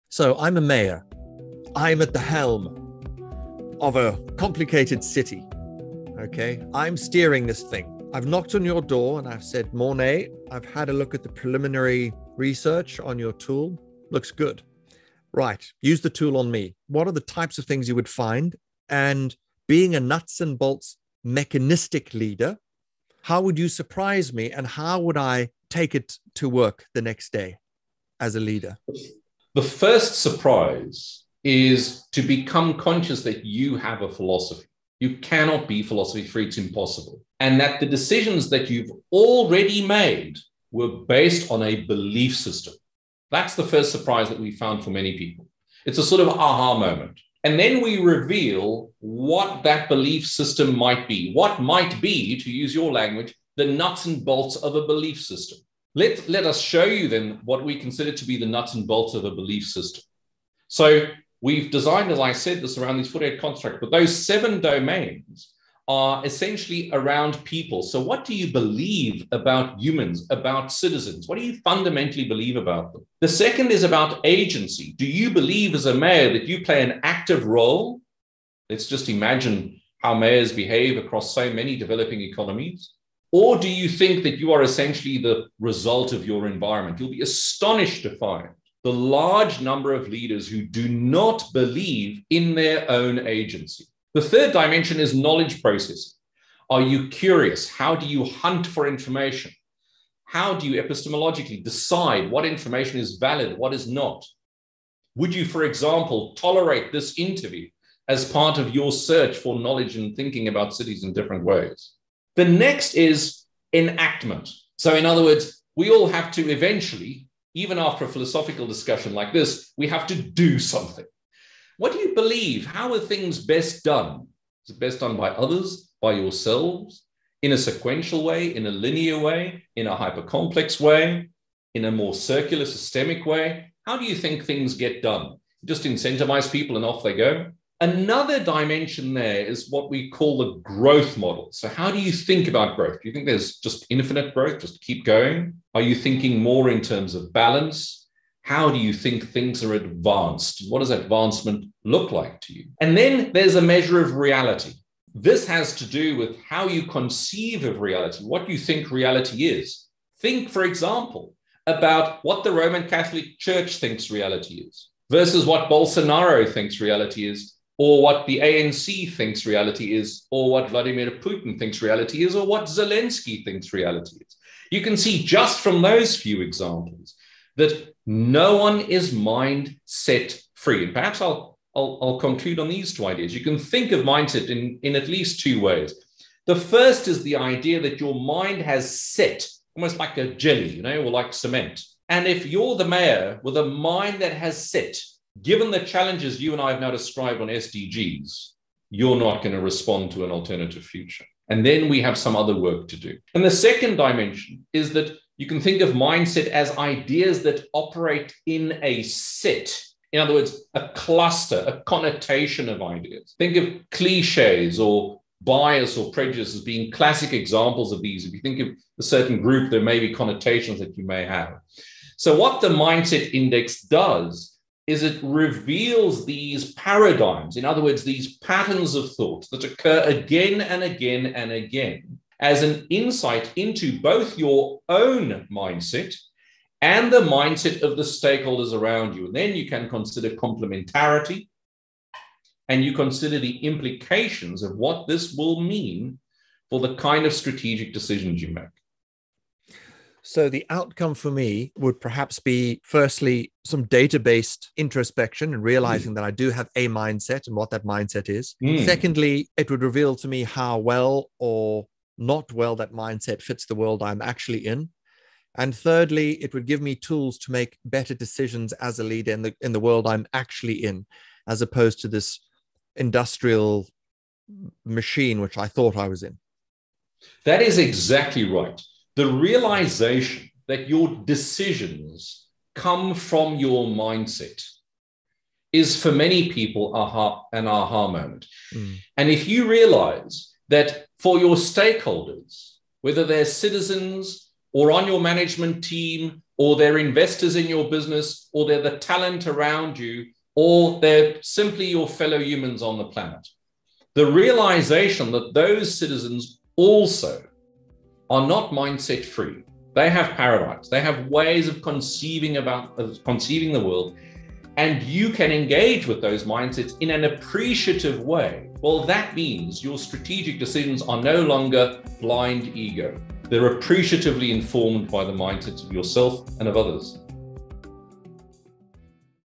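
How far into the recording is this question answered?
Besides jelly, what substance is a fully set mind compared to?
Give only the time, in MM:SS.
03:11.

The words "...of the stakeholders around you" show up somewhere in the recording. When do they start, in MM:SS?
03:57.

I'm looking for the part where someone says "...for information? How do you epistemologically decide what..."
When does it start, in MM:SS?
01:38.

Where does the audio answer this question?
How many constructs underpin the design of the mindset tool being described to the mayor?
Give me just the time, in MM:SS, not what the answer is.
01:03.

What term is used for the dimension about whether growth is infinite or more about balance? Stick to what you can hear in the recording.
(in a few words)
growth model.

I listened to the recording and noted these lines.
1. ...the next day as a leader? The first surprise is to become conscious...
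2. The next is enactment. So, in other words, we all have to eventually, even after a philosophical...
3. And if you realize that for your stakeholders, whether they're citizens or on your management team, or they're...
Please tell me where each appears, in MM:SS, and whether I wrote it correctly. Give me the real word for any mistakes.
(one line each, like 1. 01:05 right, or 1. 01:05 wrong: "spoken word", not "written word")
1. 00:26 right
2. 01:52 right
3. 04:49 right.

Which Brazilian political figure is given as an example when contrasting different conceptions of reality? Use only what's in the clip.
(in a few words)
Bolsonaro.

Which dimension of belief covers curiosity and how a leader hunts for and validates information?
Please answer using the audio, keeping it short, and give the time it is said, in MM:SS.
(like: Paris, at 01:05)
knowledge process, at 01:35.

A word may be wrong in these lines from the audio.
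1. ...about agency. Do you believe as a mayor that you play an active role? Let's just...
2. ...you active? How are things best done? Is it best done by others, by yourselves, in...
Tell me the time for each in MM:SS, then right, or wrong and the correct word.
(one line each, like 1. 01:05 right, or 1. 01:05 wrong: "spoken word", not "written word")
1. 01:13 right
2. 02:01 wrong: "believe", not "active".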